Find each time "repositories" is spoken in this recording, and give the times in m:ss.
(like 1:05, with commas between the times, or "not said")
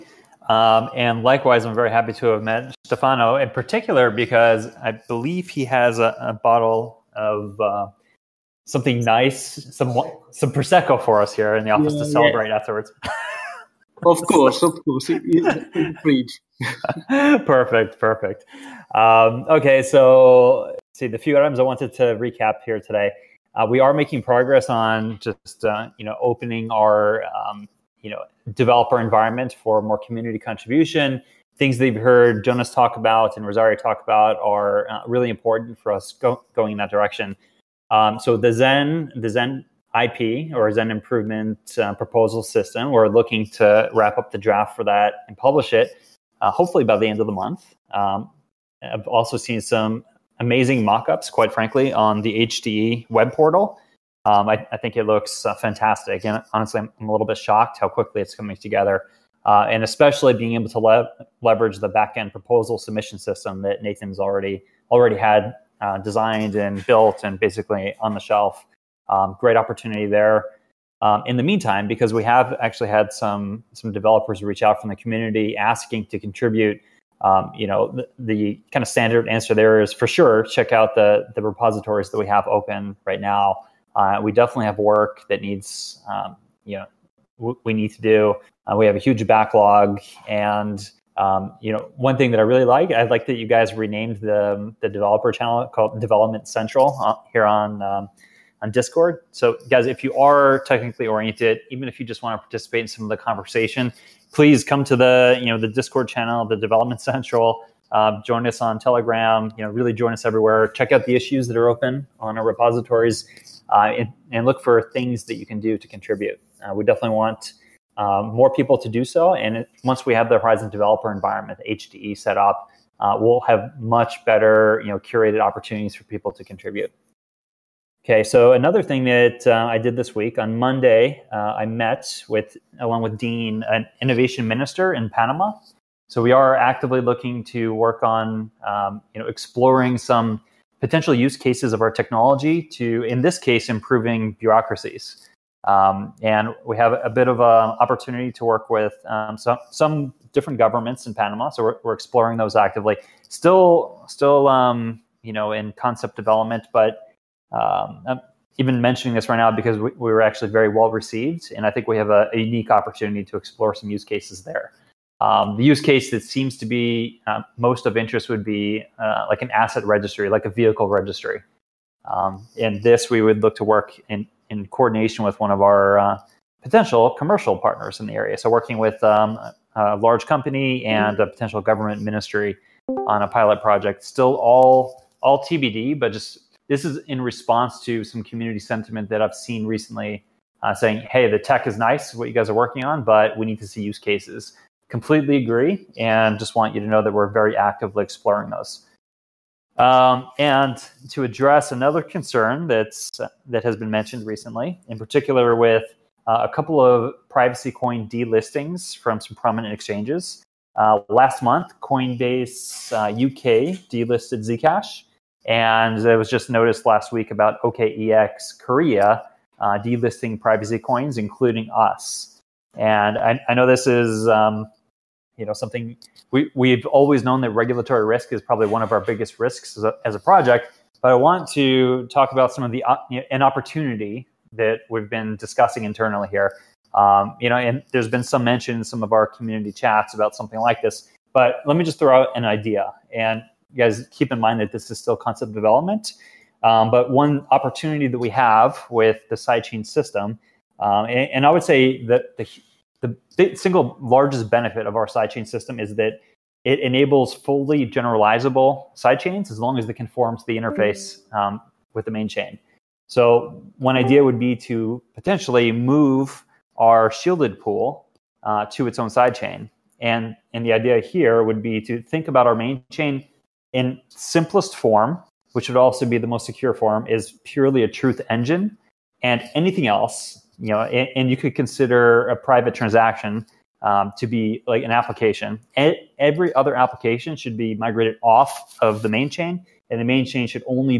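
1:21, 1:52.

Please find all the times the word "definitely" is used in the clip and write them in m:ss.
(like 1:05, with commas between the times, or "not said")
1:24, 1:56.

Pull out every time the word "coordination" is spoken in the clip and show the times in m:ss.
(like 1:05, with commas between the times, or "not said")
2:54.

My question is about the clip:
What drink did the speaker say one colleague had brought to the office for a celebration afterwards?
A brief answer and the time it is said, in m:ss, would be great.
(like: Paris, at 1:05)
prosecco, at 0:10.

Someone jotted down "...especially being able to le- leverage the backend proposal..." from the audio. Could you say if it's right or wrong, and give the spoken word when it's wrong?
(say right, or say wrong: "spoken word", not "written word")
right.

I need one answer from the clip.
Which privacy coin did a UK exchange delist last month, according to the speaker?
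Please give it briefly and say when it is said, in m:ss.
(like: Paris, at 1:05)
Zcash, at 3:34.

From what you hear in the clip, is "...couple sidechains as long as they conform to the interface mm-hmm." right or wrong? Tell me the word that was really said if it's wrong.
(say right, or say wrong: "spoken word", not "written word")
wrong: "generalizable", not "couple".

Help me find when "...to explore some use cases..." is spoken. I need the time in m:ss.
2:43.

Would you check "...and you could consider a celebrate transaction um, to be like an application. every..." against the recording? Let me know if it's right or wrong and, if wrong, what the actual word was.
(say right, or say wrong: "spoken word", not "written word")
wrong: "private", not "celebrate".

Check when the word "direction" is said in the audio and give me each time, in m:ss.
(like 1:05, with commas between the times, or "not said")
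0:36.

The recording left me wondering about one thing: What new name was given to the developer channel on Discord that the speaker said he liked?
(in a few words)
Development Central.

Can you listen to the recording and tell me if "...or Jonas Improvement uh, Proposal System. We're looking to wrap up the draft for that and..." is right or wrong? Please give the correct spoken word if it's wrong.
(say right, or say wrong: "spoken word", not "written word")
wrong: "Zen", not "Jonas".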